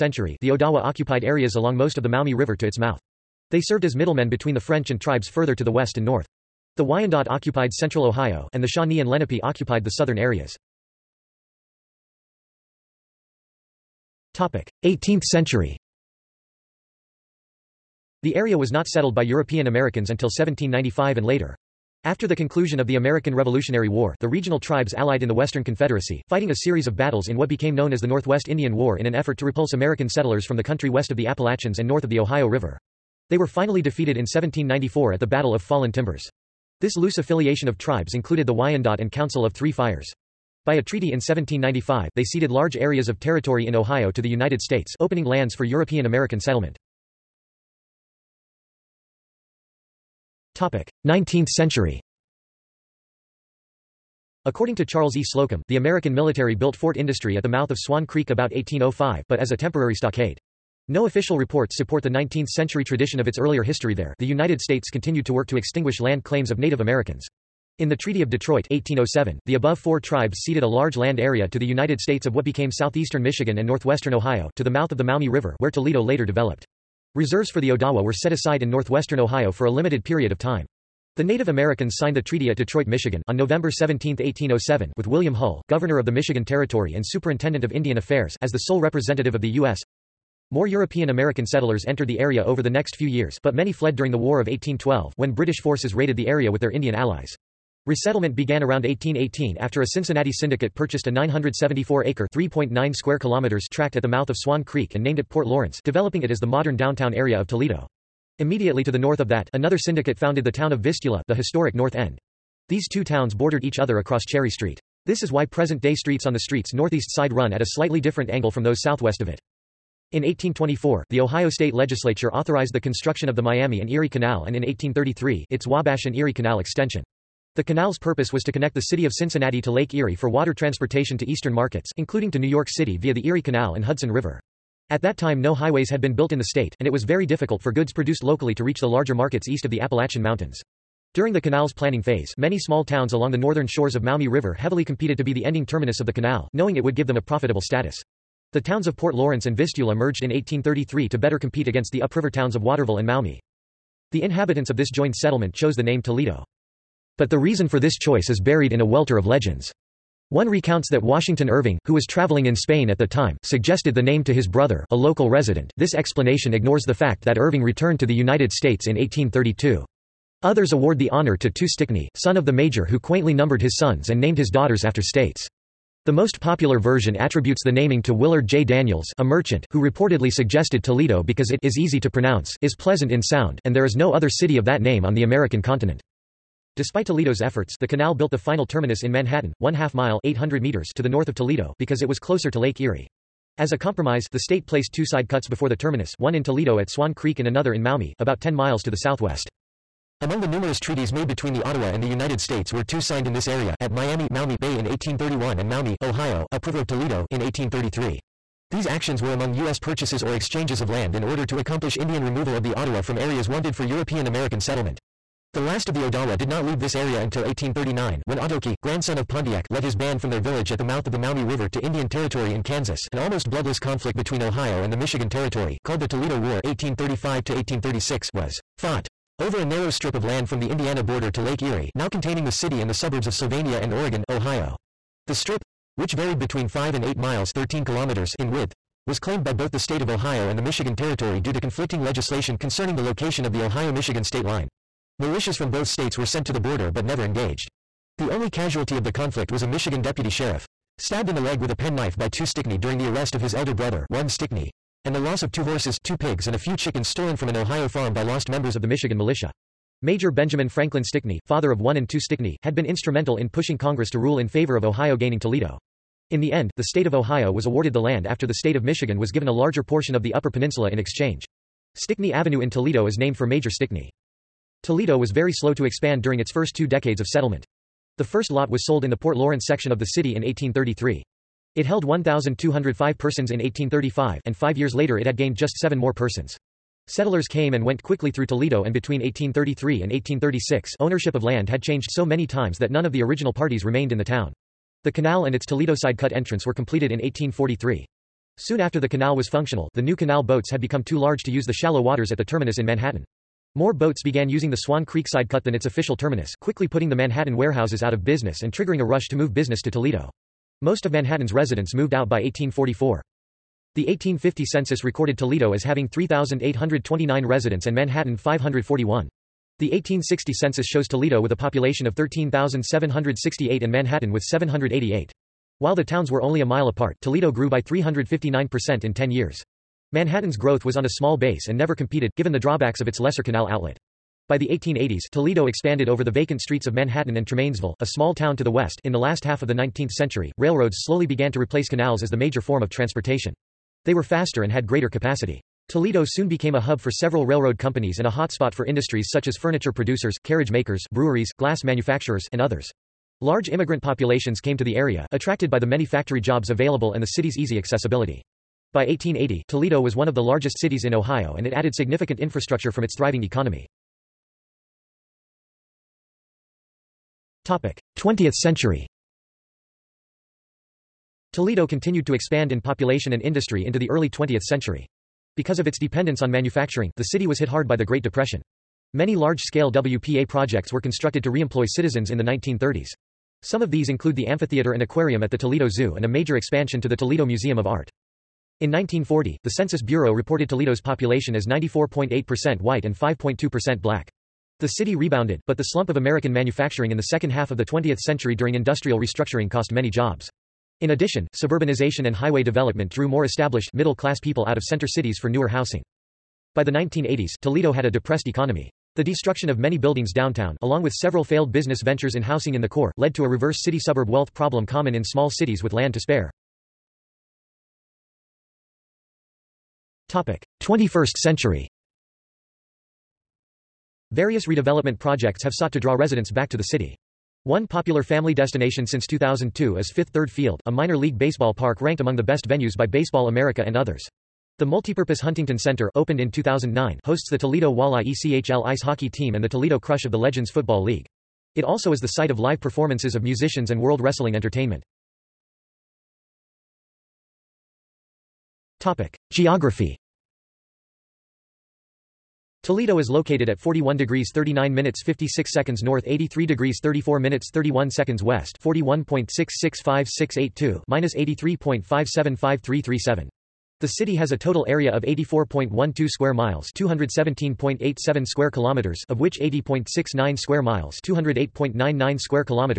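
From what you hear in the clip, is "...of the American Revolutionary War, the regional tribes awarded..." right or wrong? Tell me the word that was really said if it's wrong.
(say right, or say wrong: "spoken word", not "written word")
wrong: "allied", not "awarded".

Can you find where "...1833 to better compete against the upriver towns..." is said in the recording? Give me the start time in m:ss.
2:30.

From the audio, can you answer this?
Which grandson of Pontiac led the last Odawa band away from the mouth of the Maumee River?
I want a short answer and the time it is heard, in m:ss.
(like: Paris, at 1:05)
Otoki, at 3:38.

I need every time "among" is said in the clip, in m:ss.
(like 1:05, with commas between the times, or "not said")
3:20, 3:29, 7:12.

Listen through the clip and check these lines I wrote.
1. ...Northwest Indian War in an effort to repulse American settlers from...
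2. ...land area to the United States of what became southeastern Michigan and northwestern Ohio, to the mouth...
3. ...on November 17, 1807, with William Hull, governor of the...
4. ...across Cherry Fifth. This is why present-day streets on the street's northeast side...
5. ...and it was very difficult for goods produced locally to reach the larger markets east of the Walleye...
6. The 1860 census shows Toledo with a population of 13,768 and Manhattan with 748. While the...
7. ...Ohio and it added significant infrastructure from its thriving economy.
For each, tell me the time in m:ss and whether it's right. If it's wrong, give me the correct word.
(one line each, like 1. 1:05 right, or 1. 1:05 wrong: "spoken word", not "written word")
1. 0:28 right
2. 1:10 right
3. 1:23 right
4. 1:53 wrong: "Street", not "Fifth"
5. 2:16 wrong: "Appalachian", not "Walleye"
6. 5:19 wrong: "788", not "748"
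7. 6:01 right.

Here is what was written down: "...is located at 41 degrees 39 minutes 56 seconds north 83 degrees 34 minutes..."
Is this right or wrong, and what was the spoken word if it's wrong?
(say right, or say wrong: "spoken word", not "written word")
right.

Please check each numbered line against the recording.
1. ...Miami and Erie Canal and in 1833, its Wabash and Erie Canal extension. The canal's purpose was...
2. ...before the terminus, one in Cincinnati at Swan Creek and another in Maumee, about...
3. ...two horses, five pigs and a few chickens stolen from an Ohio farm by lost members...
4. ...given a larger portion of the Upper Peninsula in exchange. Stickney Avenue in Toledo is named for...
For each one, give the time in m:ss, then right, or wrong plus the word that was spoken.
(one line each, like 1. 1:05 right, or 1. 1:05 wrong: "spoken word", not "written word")
1. 2:03 right
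2. 3:15 wrong: "Toledo", not "Cincinnati"
3. 4:15 wrong: "two", not "five"
4. 4:29 right.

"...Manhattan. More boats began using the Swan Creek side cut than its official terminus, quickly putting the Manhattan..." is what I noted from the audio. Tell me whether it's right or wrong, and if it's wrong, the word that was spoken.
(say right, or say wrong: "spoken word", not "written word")
right.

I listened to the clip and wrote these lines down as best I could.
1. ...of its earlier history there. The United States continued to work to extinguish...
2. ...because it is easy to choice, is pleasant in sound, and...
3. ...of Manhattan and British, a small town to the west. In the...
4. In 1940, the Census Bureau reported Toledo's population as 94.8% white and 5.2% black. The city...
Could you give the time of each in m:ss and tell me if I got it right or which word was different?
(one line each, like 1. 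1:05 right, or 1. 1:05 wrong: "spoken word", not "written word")
1. 1:03 right
2. 3:01 wrong: "pronounce", not "choice"
3. 5:36 wrong: "Tremainsville", not "British"
4. 6:28 right.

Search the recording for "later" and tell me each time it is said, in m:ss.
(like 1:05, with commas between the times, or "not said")
0:21, 1:16, 4:44.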